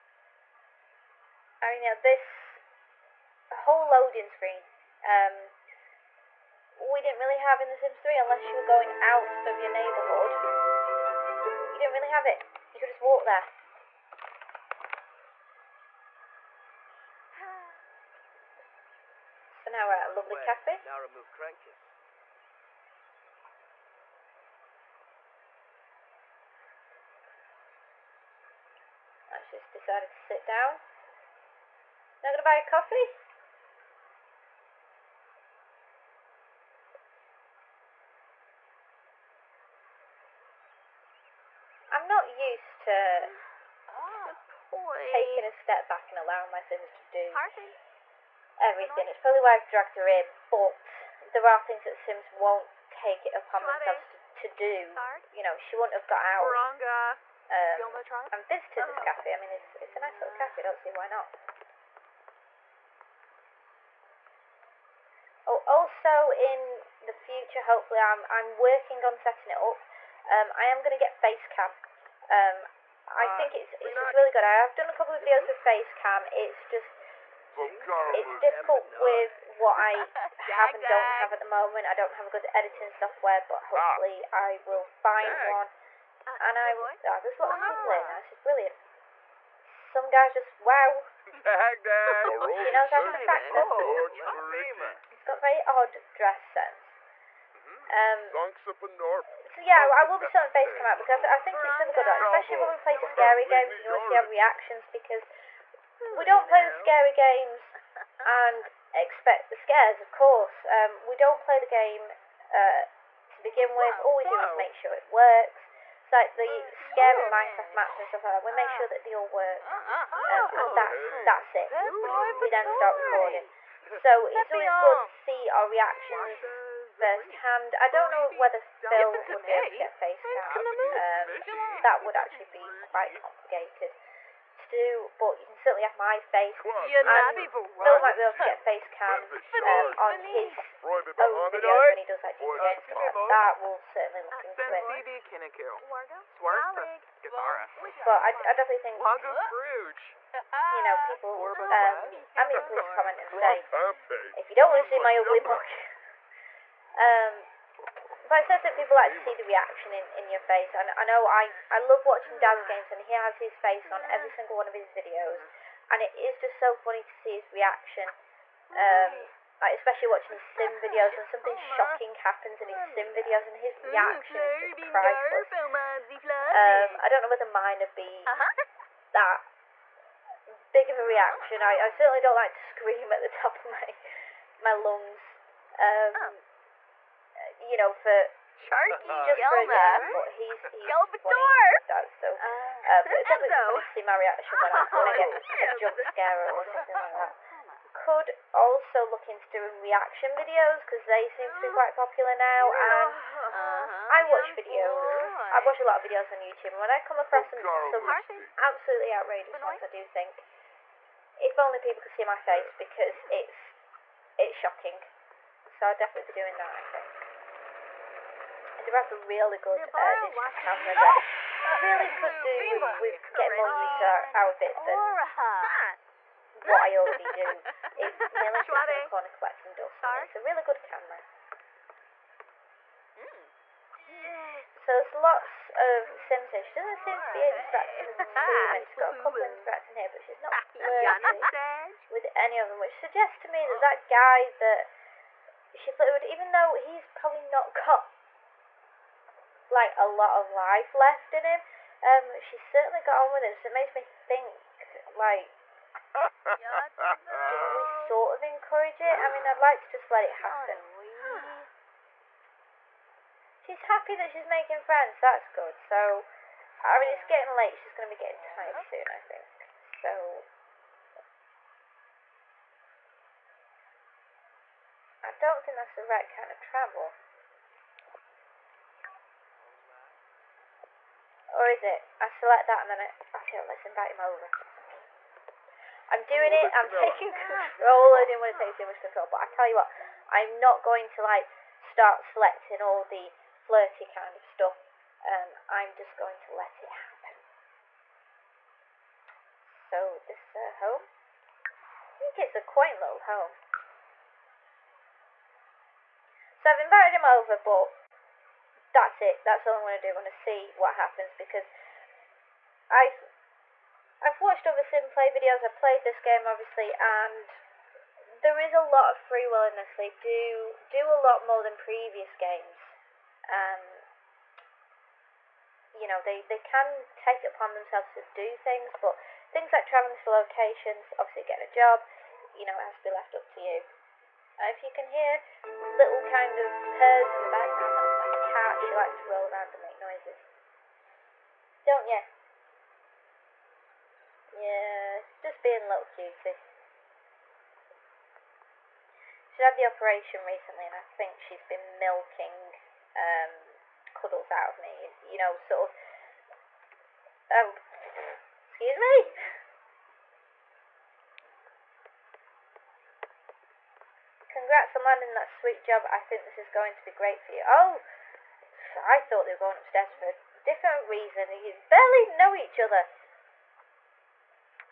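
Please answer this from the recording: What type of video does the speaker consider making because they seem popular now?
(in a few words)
reaction videos.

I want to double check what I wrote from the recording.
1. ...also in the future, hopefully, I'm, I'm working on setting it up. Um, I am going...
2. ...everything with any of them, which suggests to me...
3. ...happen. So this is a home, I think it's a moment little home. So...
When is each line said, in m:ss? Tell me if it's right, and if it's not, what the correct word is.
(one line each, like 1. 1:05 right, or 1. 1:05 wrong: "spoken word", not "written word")
1. 1:05 right
2. 4:00 wrong: "flirting", not "everything"
3. 4:56 wrong: "quaint", not "moment".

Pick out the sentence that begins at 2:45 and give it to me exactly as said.
And it is just so funny to see his reaction.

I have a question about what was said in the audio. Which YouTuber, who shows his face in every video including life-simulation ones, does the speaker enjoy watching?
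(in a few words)
Daz.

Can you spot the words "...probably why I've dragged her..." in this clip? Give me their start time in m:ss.
0:49.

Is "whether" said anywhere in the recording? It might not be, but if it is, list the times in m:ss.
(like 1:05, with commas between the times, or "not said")
2:08, 2:57.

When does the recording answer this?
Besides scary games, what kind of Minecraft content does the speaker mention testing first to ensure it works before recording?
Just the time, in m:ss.
1:56.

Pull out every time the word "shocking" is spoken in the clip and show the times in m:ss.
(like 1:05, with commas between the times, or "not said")
2:51, 3:34.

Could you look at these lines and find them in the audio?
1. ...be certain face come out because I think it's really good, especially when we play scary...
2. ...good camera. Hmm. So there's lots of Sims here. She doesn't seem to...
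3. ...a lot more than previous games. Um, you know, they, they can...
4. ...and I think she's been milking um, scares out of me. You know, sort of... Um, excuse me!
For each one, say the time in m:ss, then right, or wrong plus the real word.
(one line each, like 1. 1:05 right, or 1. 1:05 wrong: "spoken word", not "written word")
1. 1:40 right
2. 3:50 right
3. 5:21 right
4. 5:50 wrong: "cuddles", not "scares".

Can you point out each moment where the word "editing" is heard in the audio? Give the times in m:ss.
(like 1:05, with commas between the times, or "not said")
1:22.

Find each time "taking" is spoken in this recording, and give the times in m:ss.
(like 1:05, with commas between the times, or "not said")
0:45, 4:46.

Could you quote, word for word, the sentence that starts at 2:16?
Yeah, and Phil might be able to get face cam um, on his own videos when he does that.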